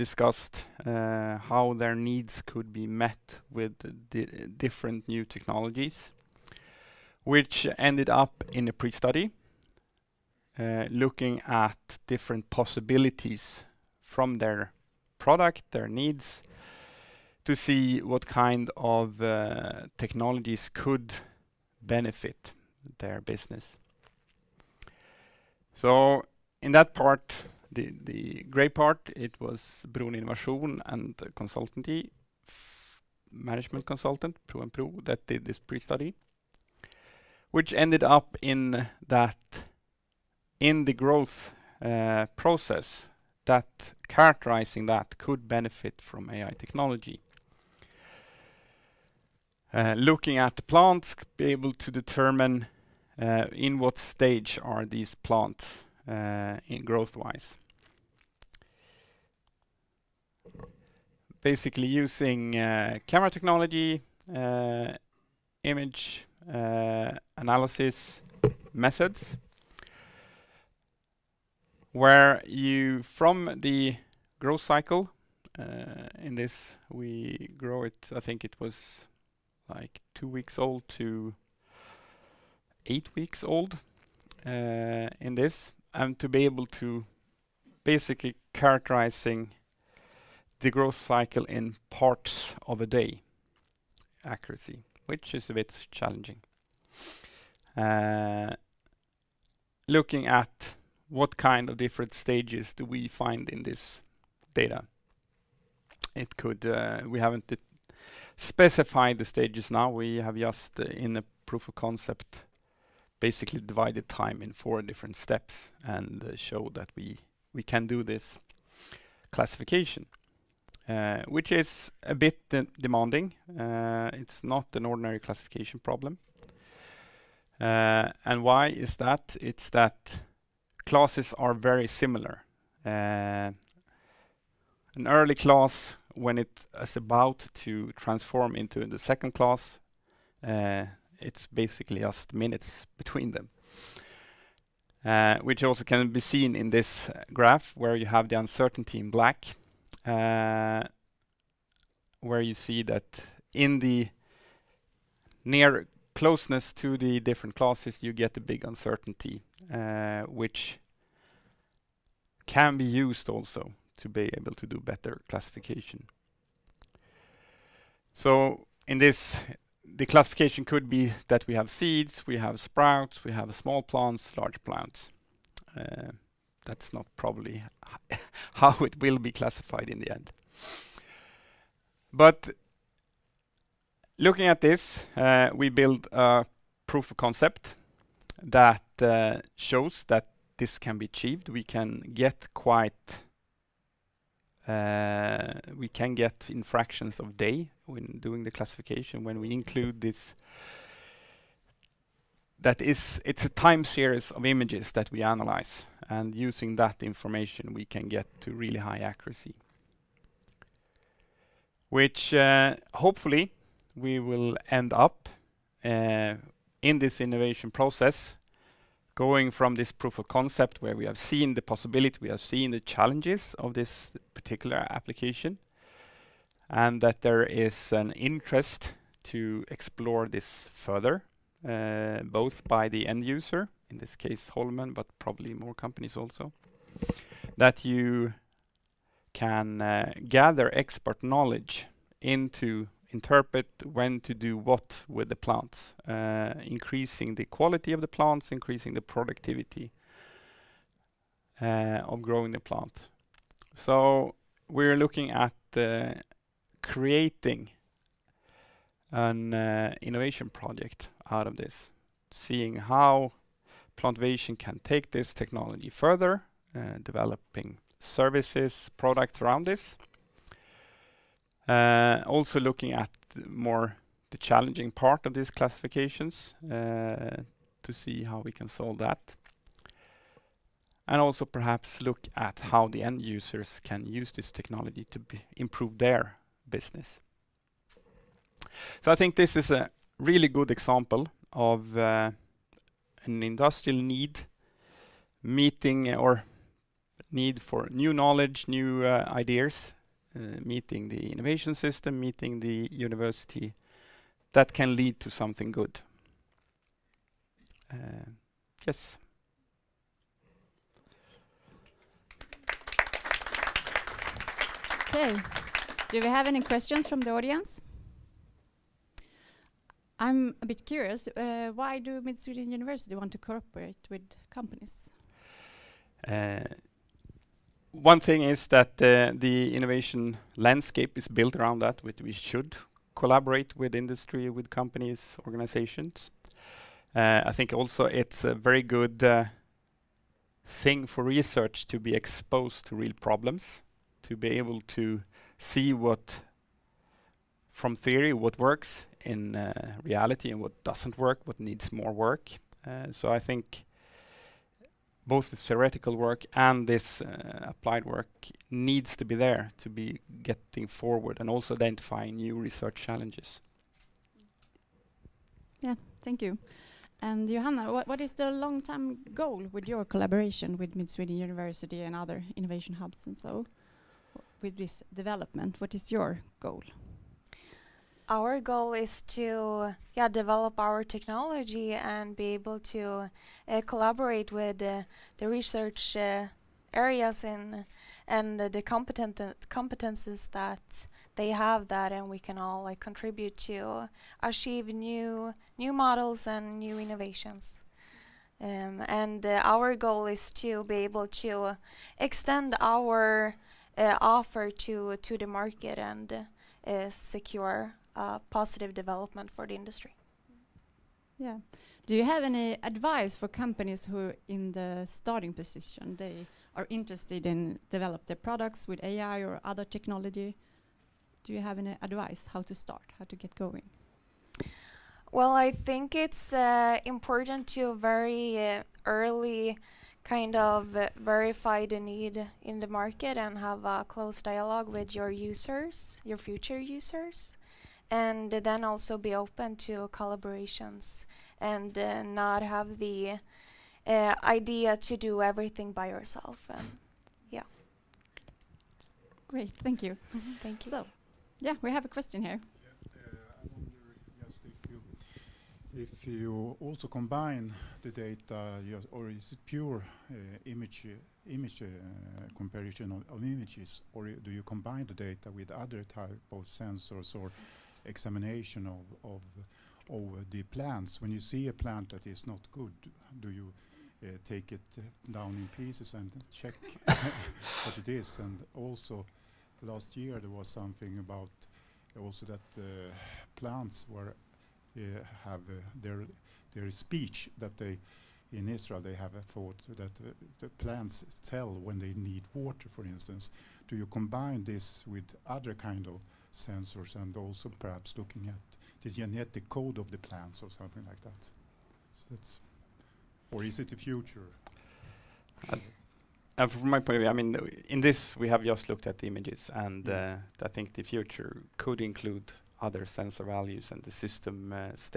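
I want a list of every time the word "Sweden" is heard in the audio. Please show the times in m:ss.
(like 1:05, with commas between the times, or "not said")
5:22, 6:11.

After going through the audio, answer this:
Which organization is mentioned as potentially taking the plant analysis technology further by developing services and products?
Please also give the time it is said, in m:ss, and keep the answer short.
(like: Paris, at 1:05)
Plantvation, at 4:23.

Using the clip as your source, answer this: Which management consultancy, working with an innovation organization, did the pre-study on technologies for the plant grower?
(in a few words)
Pro and Pro.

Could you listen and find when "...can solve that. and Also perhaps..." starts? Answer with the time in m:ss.
4:38.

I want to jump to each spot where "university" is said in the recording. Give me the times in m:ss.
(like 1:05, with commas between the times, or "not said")
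5:02, 5:22, 6:11.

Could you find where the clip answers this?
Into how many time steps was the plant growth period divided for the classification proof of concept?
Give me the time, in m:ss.
1:54.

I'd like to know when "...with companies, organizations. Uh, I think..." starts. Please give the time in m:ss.
5:34.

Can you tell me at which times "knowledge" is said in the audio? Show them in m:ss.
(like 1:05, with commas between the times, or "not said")
4:01, 4:58.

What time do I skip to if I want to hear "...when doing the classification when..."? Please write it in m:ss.
3:17.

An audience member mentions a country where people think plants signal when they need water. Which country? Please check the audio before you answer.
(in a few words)
Israel.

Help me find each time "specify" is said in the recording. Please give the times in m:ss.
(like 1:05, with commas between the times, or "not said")
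1:48.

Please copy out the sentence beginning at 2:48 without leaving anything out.
So in this, the classification could be that we have seeds, we have sprouts, we have small plants, large plants.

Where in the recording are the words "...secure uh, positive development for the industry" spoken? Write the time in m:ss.
6:47.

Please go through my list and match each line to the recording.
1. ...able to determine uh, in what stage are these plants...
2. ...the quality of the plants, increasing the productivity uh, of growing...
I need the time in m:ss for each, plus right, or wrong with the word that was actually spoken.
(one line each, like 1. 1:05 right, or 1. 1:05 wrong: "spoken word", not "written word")
1. 0:51 right
2. 4:07 right.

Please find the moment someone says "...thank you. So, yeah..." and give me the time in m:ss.
7:30.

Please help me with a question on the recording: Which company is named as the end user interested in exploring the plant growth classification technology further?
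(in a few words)
Holmen.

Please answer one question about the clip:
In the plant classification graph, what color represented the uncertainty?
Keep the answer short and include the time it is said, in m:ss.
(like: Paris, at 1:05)
Black, at 2:29.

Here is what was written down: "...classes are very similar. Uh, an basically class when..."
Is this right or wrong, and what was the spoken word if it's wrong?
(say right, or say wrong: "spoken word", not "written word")
wrong: "early", not "basically".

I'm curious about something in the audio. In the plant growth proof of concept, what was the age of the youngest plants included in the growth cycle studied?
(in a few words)
2 weeks.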